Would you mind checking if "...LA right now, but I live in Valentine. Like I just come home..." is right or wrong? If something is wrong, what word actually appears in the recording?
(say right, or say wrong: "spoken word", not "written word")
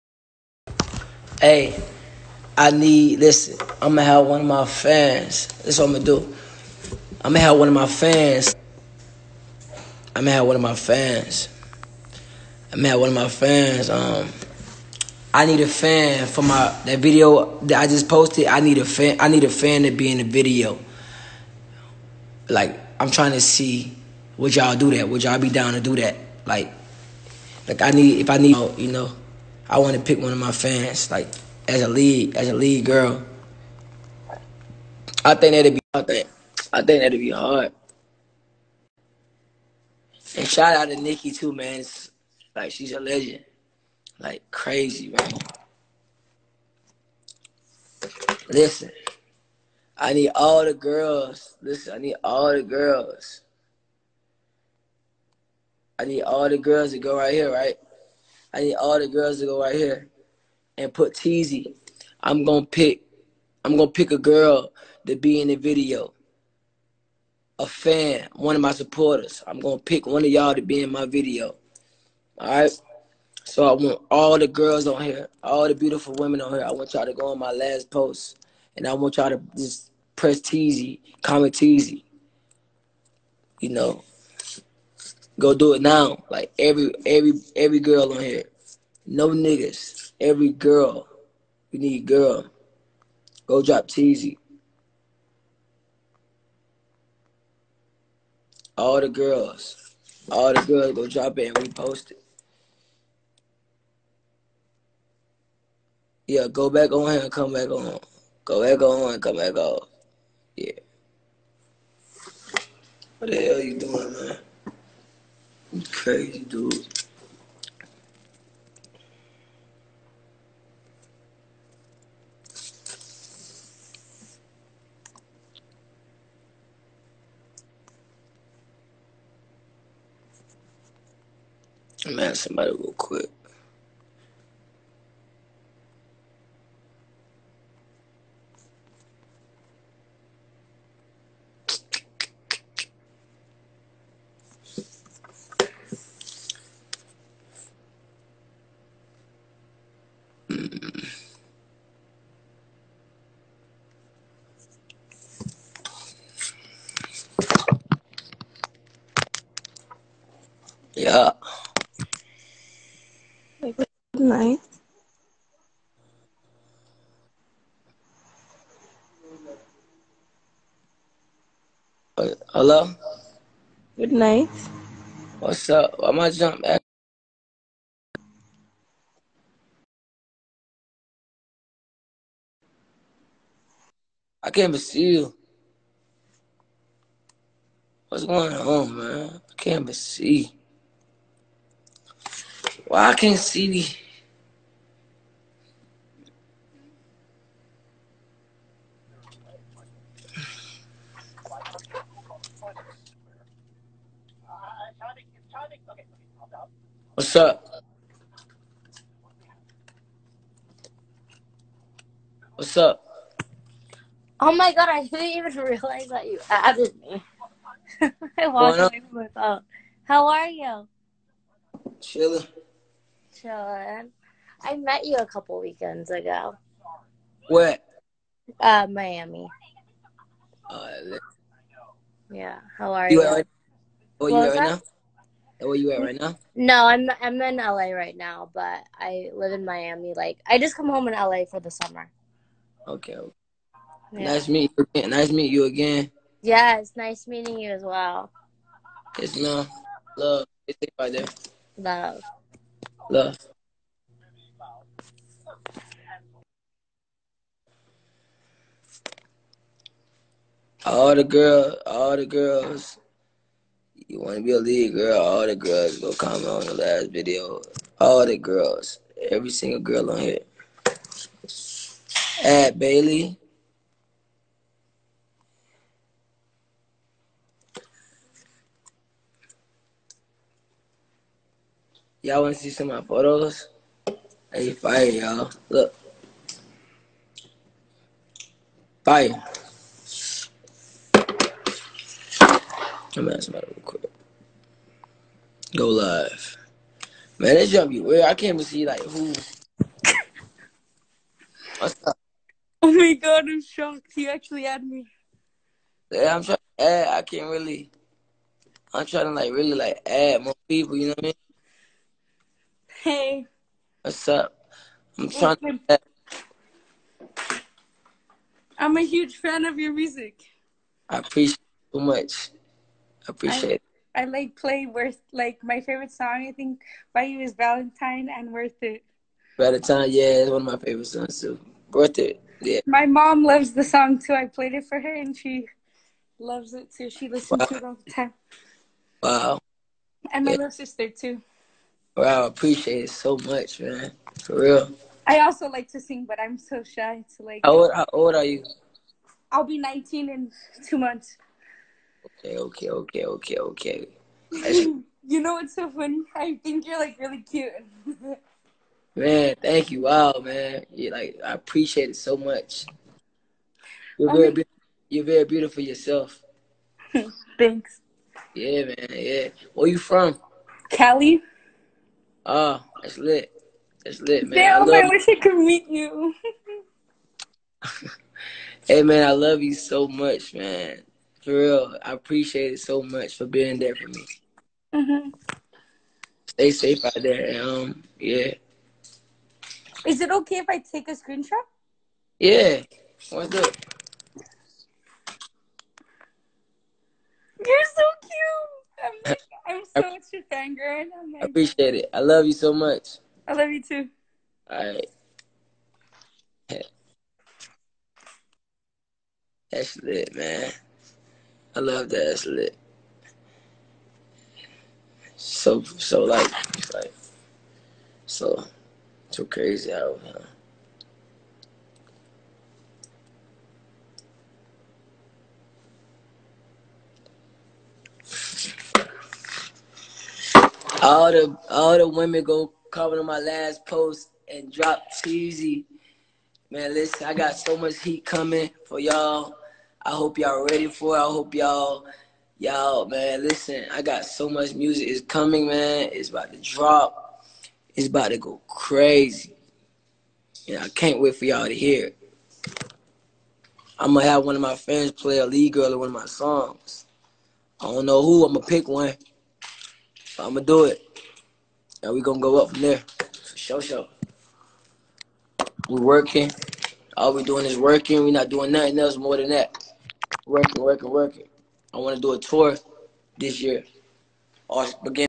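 wrong: "Miami", not "Valentine".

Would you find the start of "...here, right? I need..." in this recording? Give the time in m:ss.
0:57.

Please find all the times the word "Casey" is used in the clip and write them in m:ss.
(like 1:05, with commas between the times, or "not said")
not said.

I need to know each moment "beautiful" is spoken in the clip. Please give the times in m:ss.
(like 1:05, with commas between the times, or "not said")
1:15, 6:05.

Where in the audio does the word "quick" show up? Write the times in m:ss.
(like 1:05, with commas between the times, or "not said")
2:12, 4:53.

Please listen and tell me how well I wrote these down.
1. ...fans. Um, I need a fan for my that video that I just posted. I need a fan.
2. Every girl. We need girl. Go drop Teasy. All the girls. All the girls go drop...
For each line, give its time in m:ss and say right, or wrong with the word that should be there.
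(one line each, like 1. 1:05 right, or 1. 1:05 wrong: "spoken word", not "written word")
1. 0:13 right
2. 1:30 right.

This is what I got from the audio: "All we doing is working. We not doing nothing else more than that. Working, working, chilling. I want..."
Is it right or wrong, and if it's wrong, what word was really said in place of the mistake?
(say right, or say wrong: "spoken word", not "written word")
wrong: "working", not "chilling".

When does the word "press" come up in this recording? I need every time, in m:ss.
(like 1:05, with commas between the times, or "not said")
1:20.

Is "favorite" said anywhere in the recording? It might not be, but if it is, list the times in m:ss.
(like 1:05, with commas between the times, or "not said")
5:25, 5:30.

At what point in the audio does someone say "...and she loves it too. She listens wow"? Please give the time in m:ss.
5:35.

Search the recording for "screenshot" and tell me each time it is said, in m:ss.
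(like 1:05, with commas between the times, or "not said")
6:31.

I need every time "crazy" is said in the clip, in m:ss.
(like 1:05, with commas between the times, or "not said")
0:44, 6:59, 7:28.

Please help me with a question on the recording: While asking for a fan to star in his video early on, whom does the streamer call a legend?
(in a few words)
Nicki.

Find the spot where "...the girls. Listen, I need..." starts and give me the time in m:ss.
0:50.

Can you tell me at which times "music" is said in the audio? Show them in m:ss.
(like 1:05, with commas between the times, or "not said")
5:19, 7:24.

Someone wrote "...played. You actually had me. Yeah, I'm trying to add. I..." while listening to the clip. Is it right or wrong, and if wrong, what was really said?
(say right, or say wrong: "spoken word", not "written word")
wrong: "shocked", not "played".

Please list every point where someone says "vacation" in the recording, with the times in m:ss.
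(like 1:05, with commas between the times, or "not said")
not said.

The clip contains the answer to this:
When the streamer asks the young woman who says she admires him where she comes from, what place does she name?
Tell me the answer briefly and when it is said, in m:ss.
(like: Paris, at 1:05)
Cali, at 6:10.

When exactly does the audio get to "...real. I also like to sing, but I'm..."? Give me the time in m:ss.
5:44.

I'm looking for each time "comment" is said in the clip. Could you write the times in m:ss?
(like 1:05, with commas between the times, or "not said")
1:21, 4:26, 7:12.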